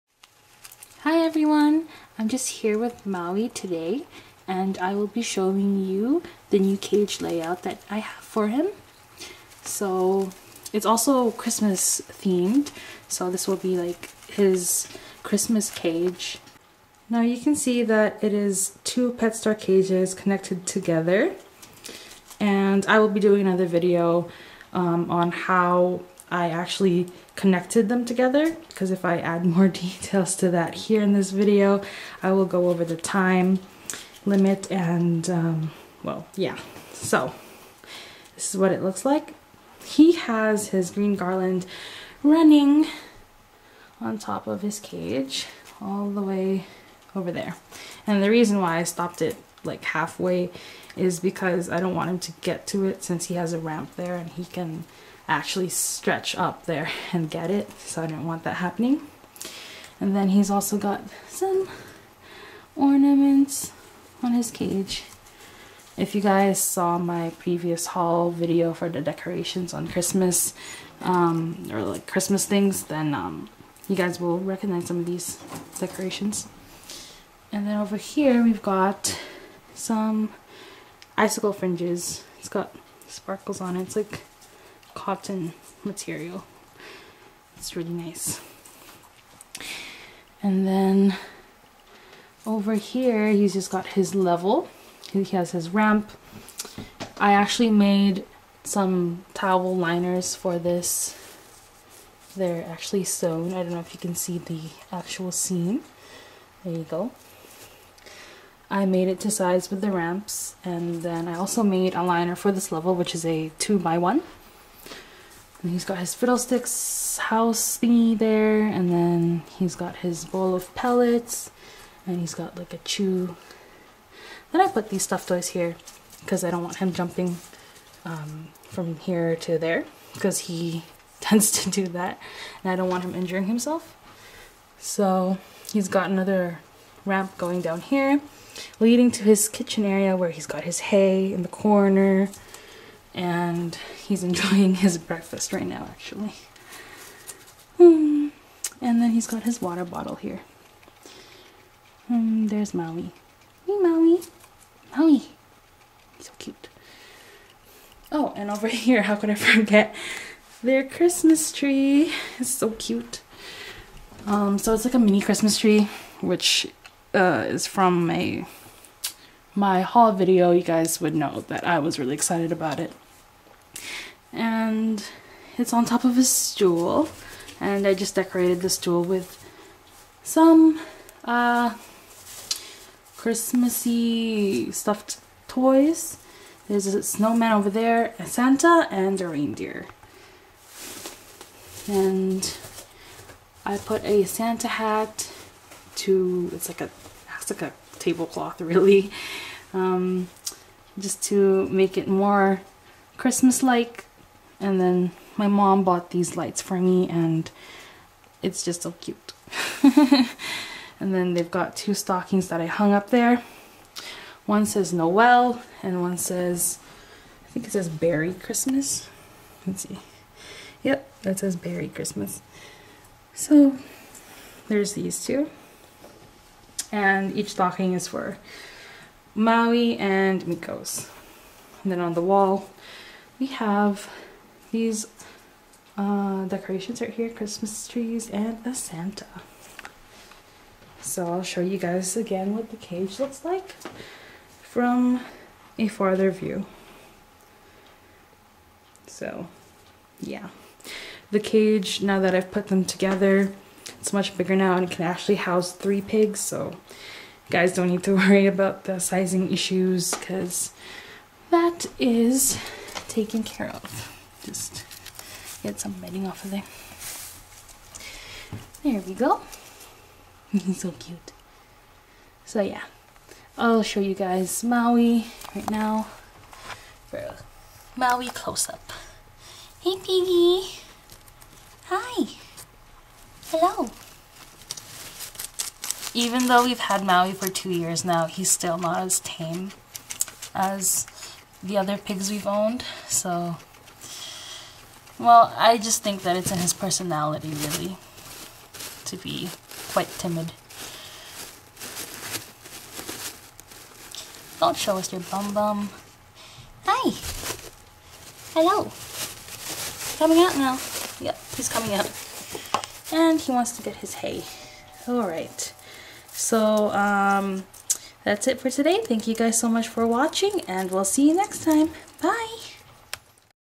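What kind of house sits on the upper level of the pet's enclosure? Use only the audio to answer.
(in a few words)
Fiddlesticks house.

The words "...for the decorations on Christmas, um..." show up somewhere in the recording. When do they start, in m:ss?
1:08.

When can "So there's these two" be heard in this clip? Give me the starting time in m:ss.
3:43.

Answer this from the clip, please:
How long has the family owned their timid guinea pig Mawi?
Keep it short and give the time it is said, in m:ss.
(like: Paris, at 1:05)
2 years, at 4:47.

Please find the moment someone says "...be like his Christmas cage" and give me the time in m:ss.
0:13.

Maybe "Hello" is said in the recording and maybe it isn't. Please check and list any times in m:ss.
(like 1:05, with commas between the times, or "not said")
4:43, 5:08.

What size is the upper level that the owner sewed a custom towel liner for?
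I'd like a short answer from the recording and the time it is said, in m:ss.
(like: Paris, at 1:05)
2 by 1, at 1:53.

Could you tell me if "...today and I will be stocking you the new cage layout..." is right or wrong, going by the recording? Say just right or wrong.
wrong.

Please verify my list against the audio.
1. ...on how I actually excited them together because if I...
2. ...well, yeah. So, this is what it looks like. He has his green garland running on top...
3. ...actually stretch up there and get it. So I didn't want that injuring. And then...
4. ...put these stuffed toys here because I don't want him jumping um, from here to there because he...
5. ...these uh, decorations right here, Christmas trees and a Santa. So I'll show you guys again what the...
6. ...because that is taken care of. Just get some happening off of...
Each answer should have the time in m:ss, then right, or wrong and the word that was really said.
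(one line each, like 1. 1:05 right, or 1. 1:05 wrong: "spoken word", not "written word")
1. 0:25 wrong: "connected", not "excited"
2. 0:36 right
3. 0:55 wrong: "happening", not "injuring"
4. 2:04 right
5. 3:54 right
6. 4:20 wrong: "bedding", not "happening".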